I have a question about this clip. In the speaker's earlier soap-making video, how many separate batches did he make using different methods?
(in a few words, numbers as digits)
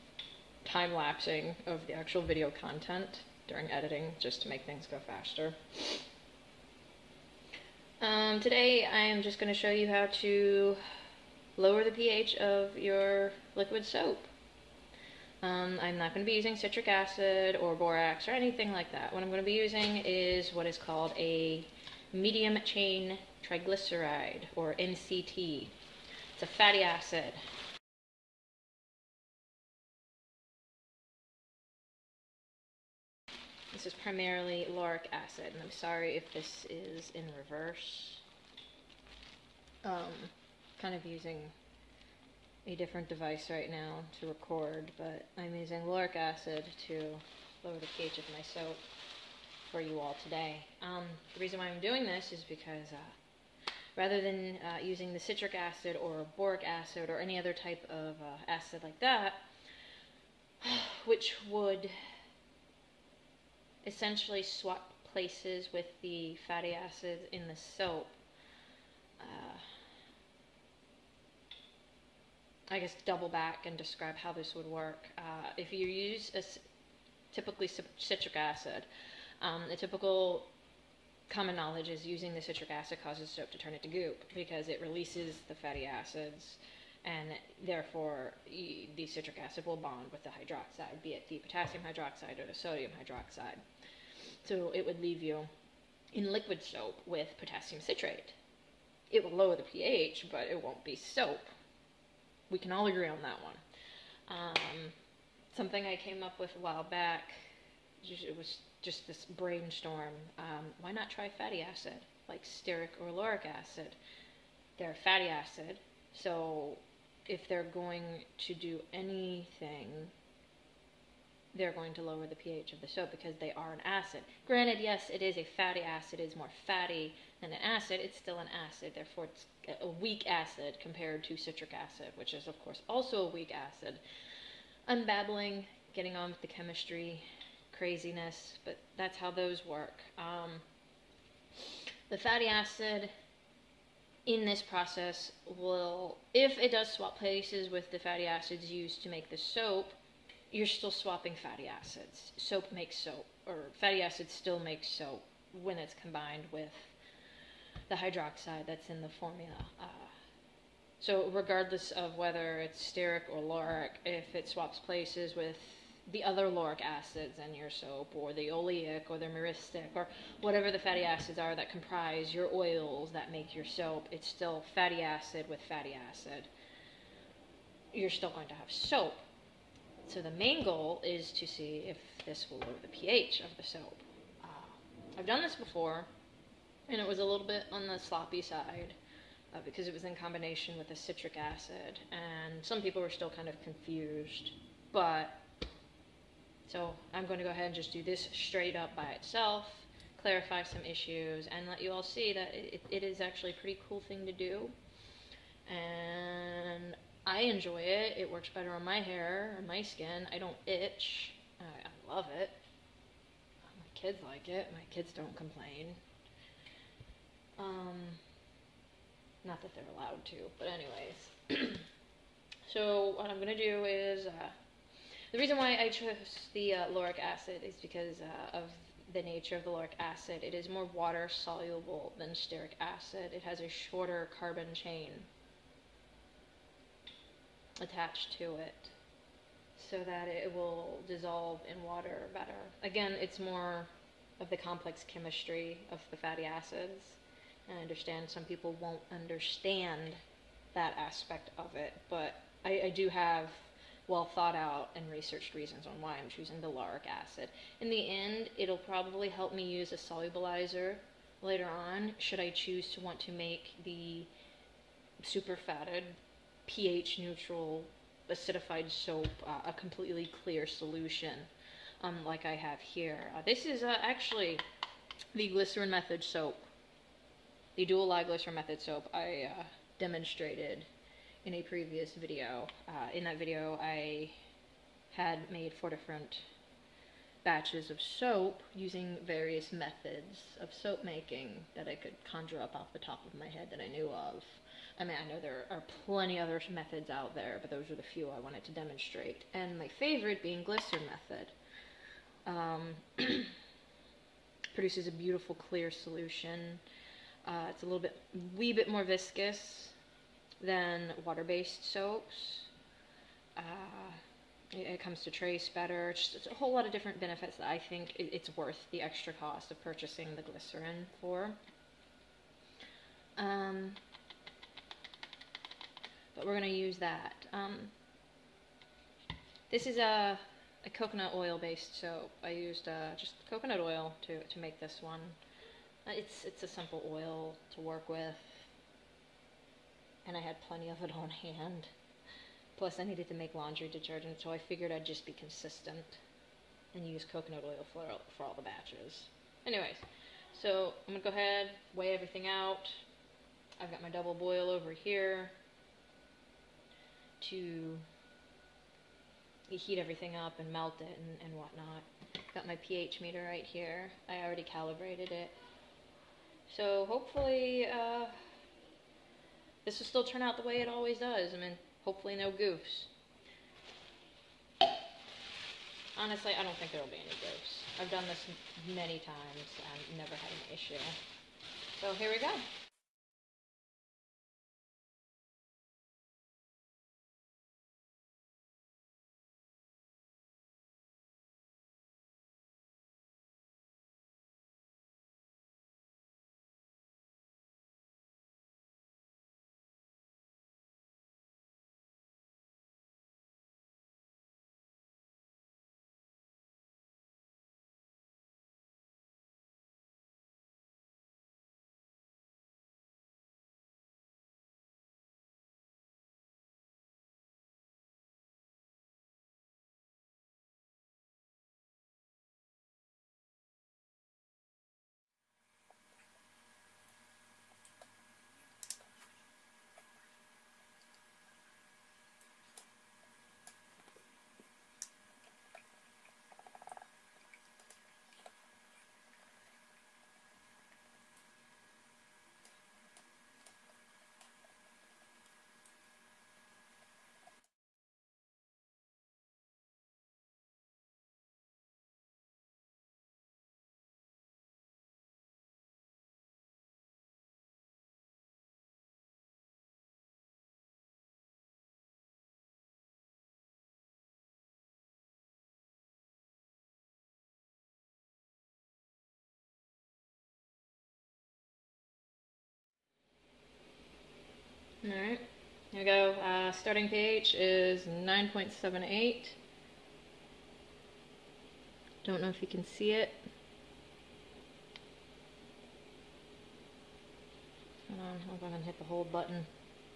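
4.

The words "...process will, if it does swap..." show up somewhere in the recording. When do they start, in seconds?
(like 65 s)
144 s.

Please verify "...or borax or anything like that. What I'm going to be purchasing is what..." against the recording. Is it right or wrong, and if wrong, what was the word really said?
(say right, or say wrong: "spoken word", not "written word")
wrong: "using", not "purchasing".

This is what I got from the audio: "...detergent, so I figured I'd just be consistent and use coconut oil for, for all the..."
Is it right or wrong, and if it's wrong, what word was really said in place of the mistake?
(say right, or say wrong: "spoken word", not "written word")
right.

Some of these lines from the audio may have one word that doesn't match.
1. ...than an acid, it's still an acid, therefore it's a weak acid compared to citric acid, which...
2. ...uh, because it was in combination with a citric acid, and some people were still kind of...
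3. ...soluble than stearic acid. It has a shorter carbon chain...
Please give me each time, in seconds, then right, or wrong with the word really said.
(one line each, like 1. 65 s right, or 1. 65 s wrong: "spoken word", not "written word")
1. 127 s right
2. 189 s right
3. 231 s right.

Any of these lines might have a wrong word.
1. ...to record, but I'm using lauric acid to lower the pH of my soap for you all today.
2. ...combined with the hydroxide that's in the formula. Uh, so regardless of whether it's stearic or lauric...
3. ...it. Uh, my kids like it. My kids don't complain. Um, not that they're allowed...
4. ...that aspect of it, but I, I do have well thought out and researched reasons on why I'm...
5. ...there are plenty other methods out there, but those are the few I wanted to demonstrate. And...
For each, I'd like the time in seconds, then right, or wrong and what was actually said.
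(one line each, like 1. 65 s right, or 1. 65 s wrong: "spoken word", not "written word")
1. 44 s right
2. 156 s right
3. 212 s right
4. 250 s right
5. 295 s right.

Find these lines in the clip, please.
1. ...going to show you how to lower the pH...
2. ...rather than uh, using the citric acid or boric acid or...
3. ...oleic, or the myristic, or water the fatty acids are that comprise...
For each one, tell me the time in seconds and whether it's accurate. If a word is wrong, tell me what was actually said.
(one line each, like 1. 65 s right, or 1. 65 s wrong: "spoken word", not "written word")
1. 9 s right
2. 53 s right
3. 168 s wrong: "whatever", not "water".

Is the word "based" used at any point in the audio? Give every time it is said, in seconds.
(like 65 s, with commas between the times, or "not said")
311 s, 331 s.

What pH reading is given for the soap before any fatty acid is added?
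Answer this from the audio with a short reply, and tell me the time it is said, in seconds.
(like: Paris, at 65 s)
9.78, at 478 s.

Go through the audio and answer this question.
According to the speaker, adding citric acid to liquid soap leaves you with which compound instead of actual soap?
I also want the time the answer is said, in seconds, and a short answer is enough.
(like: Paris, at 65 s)
potassium citrate, at 97 s.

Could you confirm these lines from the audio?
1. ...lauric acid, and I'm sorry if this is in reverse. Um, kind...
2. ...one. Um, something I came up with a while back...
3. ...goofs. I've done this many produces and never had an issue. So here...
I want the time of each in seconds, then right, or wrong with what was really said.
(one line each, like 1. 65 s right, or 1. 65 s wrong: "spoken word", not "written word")
1. 34 s right
2. 103 s right
3. 377 s wrong: "times", not "produces".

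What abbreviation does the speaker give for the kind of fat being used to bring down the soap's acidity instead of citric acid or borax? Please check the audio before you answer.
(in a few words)
MCT.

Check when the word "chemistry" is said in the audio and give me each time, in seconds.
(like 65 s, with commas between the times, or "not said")
136 s, 245 s.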